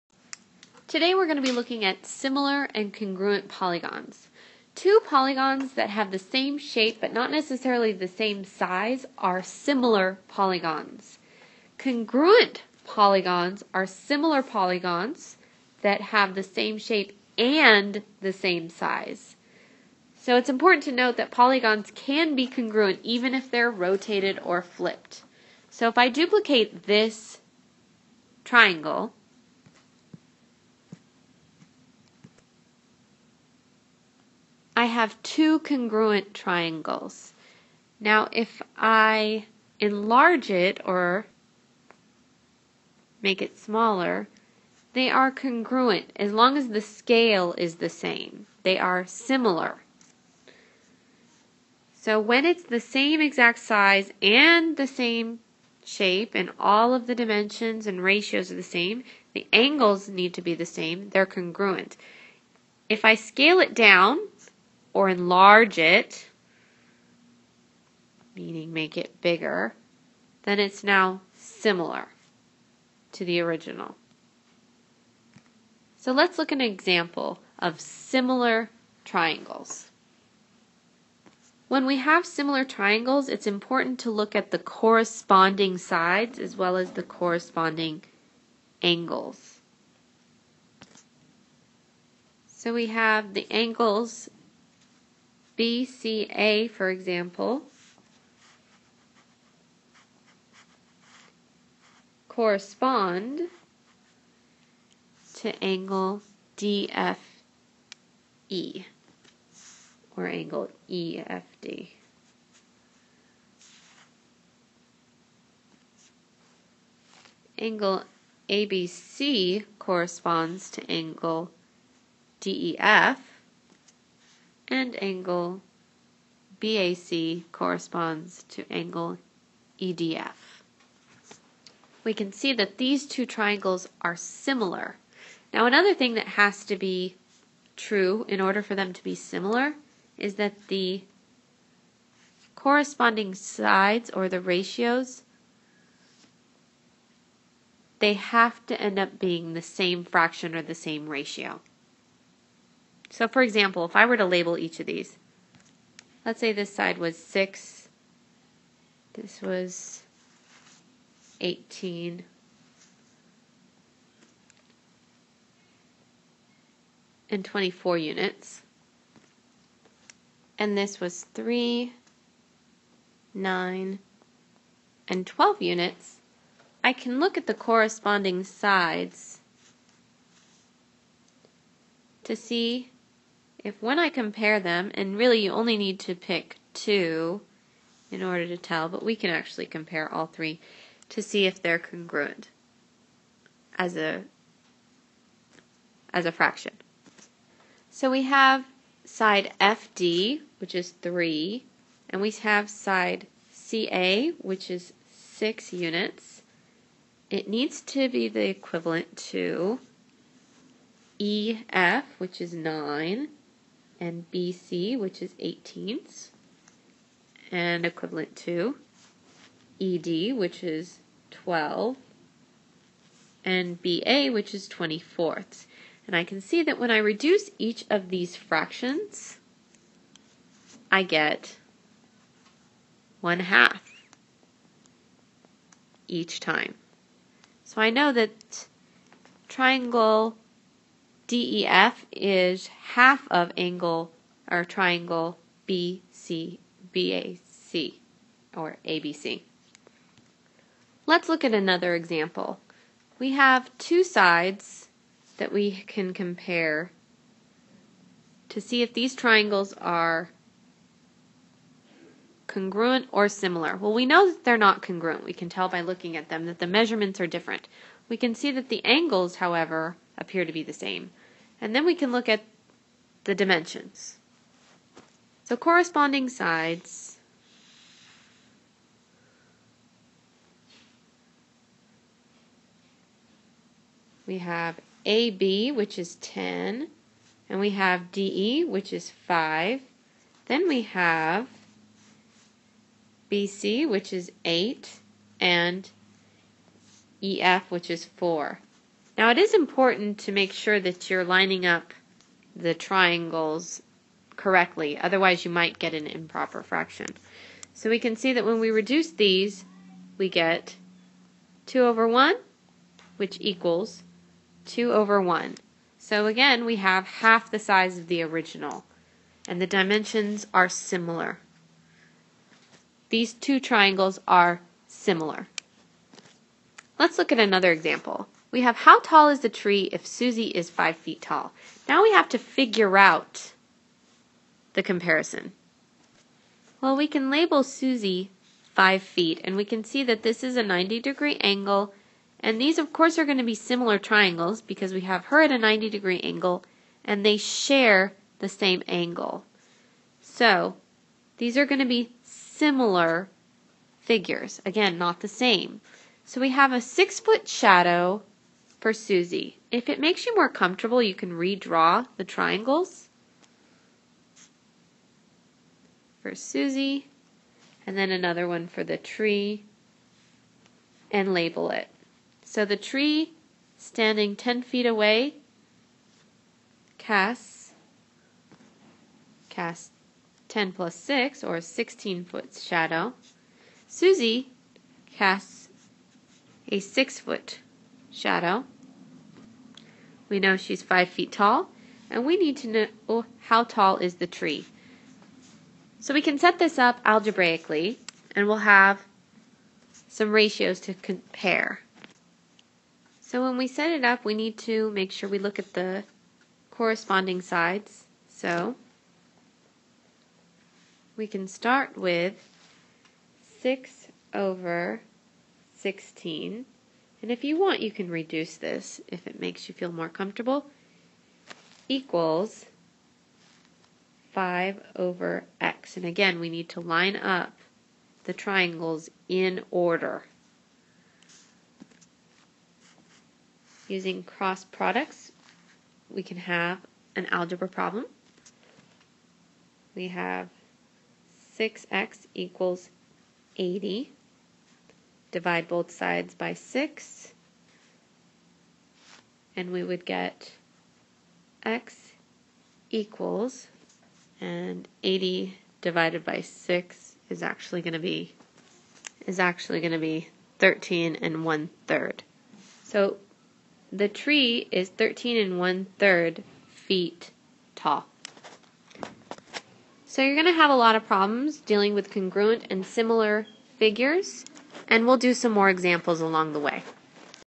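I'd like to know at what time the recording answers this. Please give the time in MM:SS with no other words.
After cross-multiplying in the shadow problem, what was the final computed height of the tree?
07:44.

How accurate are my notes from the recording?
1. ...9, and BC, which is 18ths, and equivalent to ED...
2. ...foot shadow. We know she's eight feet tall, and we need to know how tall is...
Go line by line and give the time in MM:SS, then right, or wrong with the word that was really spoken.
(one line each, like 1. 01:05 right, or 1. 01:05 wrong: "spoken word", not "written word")
1. 03:32 right
2. 06:27 wrong: "five", not "eight".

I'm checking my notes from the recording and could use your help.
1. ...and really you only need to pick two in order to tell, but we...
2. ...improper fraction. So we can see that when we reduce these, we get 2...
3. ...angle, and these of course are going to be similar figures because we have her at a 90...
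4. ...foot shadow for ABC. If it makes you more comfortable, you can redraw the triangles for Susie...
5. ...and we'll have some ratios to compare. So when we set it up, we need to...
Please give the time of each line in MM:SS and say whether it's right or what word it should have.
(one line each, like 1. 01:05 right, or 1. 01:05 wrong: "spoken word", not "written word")
1. 03:04 right
2. 05:06 right
3. 05:41 wrong: "triangles", not "figures"
4. 05:57 wrong: "Susie", not "ABC"
5. 06:38 right.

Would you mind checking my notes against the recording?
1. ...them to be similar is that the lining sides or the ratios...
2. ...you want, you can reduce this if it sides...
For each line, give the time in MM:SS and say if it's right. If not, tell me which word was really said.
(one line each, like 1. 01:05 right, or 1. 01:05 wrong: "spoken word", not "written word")
1. 02:18 wrong: "corresponding", not "lining"
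2. 06:57 wrong: "makes", not "sides".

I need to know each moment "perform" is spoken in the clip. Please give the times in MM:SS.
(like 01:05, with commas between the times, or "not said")
not said.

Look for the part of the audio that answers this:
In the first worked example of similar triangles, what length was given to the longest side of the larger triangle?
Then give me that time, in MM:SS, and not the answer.
02:47.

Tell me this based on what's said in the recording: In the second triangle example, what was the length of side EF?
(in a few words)
4.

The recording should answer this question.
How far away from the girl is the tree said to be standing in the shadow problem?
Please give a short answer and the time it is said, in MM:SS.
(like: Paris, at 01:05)
10 feet, at 06:14.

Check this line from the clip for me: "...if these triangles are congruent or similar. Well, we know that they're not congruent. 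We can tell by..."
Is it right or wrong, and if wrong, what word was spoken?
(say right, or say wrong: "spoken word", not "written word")
right.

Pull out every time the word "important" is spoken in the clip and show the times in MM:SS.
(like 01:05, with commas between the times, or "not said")
00:20, 01:23, 04:59.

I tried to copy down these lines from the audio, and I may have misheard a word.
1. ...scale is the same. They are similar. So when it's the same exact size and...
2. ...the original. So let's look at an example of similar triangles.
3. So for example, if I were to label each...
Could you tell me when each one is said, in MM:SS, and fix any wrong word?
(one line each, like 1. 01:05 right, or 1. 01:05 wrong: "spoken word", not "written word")
1. 00:46 right
2. 01:13 right
3. 02:33 right.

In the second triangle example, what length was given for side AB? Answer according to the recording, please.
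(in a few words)
10.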